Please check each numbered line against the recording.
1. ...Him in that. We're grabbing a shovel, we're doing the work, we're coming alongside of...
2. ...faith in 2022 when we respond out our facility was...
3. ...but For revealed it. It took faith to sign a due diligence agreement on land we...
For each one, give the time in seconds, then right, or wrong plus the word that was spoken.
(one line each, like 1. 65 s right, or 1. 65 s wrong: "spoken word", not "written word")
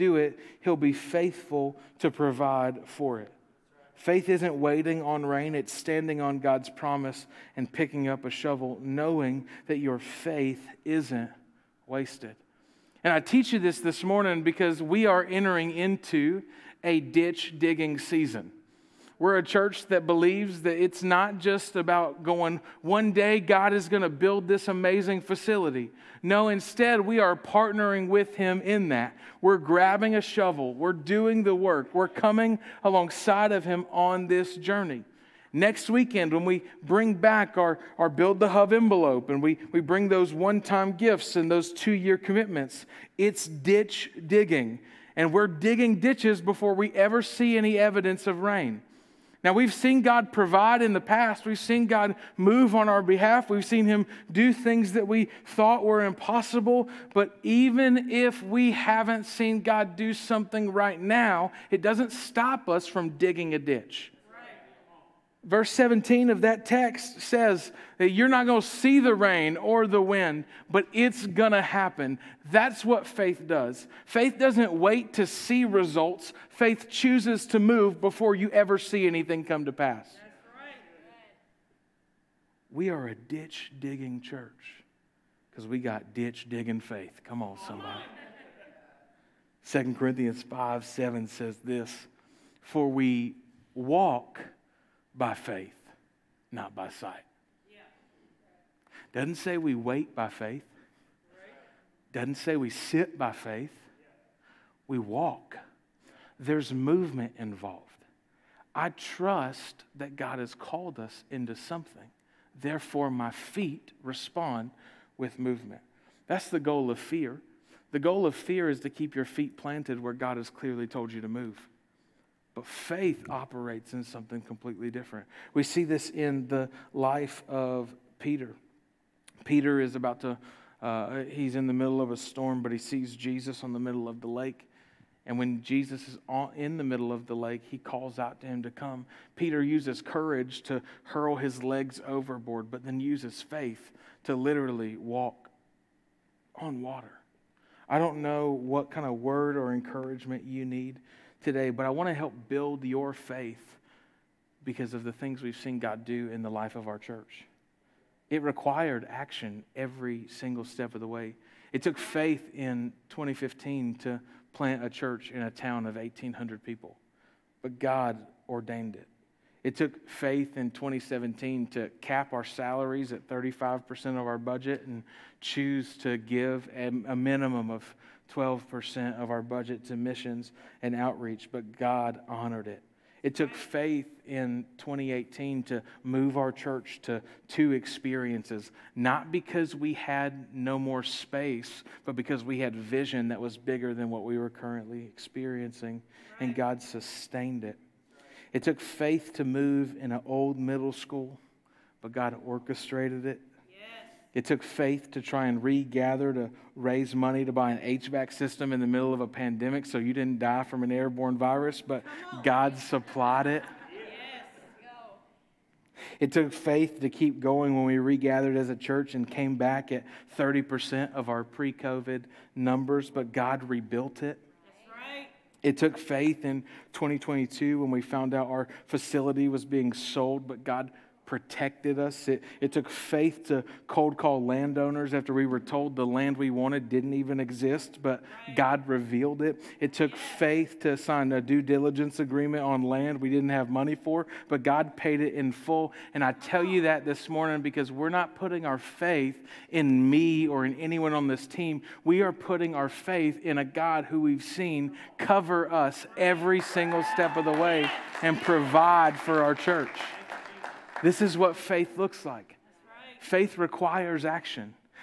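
1. 28 s right
2. 225 s wrong: "found", not "respond"
3. 238 s wrong: "God", not "For".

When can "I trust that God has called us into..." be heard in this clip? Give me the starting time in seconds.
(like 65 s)
108 s.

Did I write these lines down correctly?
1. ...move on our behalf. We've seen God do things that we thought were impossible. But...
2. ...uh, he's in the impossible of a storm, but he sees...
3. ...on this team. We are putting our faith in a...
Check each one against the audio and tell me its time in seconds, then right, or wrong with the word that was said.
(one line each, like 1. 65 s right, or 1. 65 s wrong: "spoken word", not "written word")
1. 52 s wrong: "Him", not "God"
2. 130 s wrong: "middle", not "impossible"
3. 251 s right.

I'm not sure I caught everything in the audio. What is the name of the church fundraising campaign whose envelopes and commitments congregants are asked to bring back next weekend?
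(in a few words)
Build the Hub.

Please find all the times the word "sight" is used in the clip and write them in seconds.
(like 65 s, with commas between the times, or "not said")
96 s.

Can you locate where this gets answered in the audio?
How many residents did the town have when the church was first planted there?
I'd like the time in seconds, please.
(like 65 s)
165 s.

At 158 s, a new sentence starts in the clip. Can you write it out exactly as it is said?
It required action every single step of the way.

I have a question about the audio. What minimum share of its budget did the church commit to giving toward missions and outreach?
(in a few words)
12%.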